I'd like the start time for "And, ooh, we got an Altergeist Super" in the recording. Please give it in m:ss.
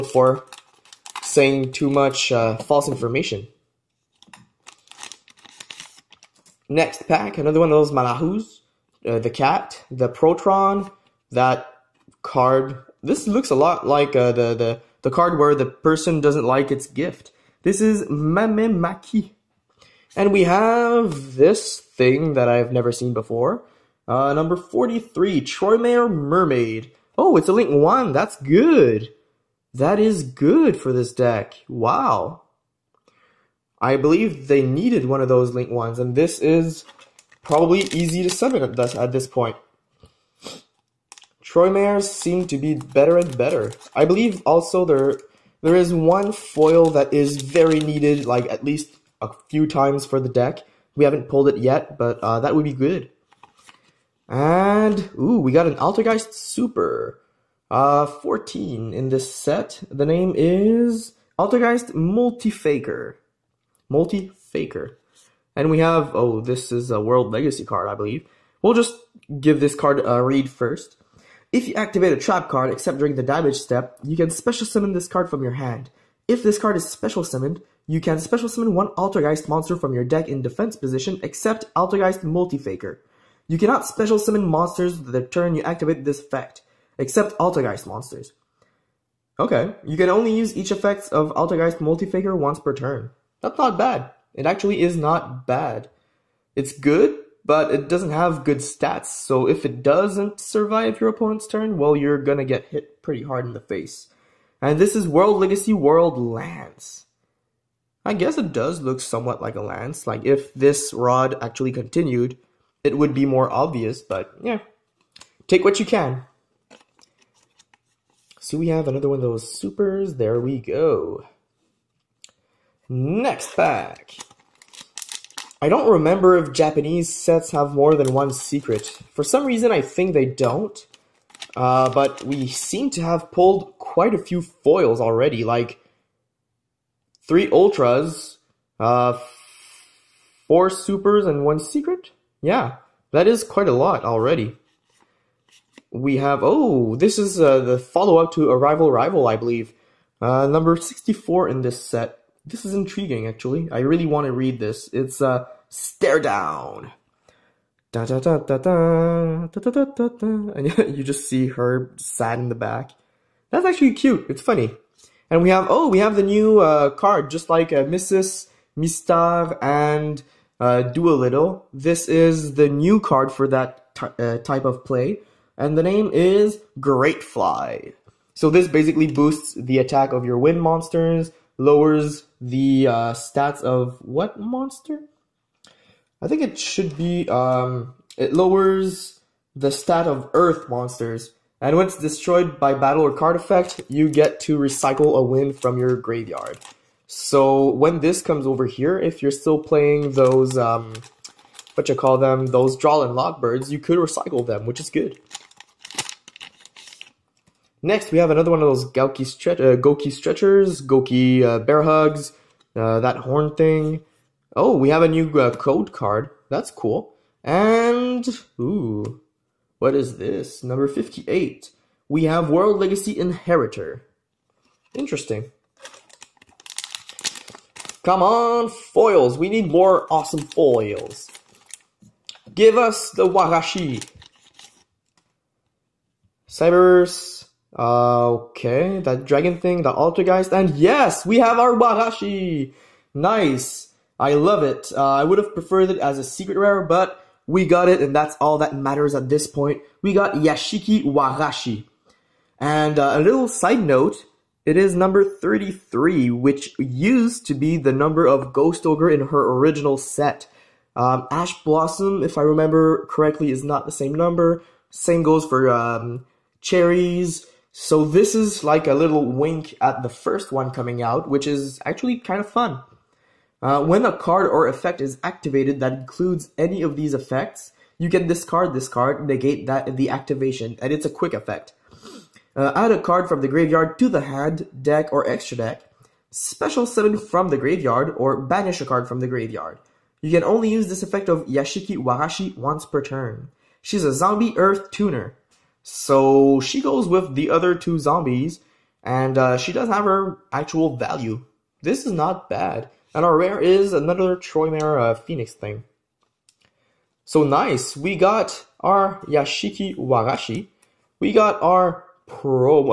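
0:54.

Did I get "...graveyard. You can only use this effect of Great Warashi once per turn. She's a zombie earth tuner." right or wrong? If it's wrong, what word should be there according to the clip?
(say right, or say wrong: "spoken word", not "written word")
wrong: "Yashiki", not "Great".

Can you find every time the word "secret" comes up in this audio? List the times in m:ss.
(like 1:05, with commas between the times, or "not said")
2:08, 2:21, 4:06.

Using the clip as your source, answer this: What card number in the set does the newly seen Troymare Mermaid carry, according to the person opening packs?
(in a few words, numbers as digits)
43.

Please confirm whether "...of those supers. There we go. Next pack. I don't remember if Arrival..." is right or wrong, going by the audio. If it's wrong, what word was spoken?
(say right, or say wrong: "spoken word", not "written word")
wrong: "Japanese", not "Arrival".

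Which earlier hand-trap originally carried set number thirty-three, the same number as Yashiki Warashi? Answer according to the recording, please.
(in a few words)
Ghost Ogre.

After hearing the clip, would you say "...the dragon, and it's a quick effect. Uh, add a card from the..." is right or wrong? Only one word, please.
wrong.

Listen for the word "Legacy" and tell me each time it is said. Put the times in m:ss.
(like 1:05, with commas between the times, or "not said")
1:07, 1:45, 3:42.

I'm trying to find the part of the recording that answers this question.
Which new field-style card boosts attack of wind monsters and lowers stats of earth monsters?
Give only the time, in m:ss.
2:56.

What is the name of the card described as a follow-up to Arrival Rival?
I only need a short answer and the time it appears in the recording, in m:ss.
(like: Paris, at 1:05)
Stare Down, at 2:35.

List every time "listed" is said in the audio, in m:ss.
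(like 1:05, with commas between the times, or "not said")
not said.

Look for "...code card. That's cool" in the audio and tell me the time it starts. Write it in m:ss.
3:35.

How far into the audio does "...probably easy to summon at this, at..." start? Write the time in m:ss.
0:37.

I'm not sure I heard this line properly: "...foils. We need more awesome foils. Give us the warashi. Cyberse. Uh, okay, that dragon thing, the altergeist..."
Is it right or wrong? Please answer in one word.
right.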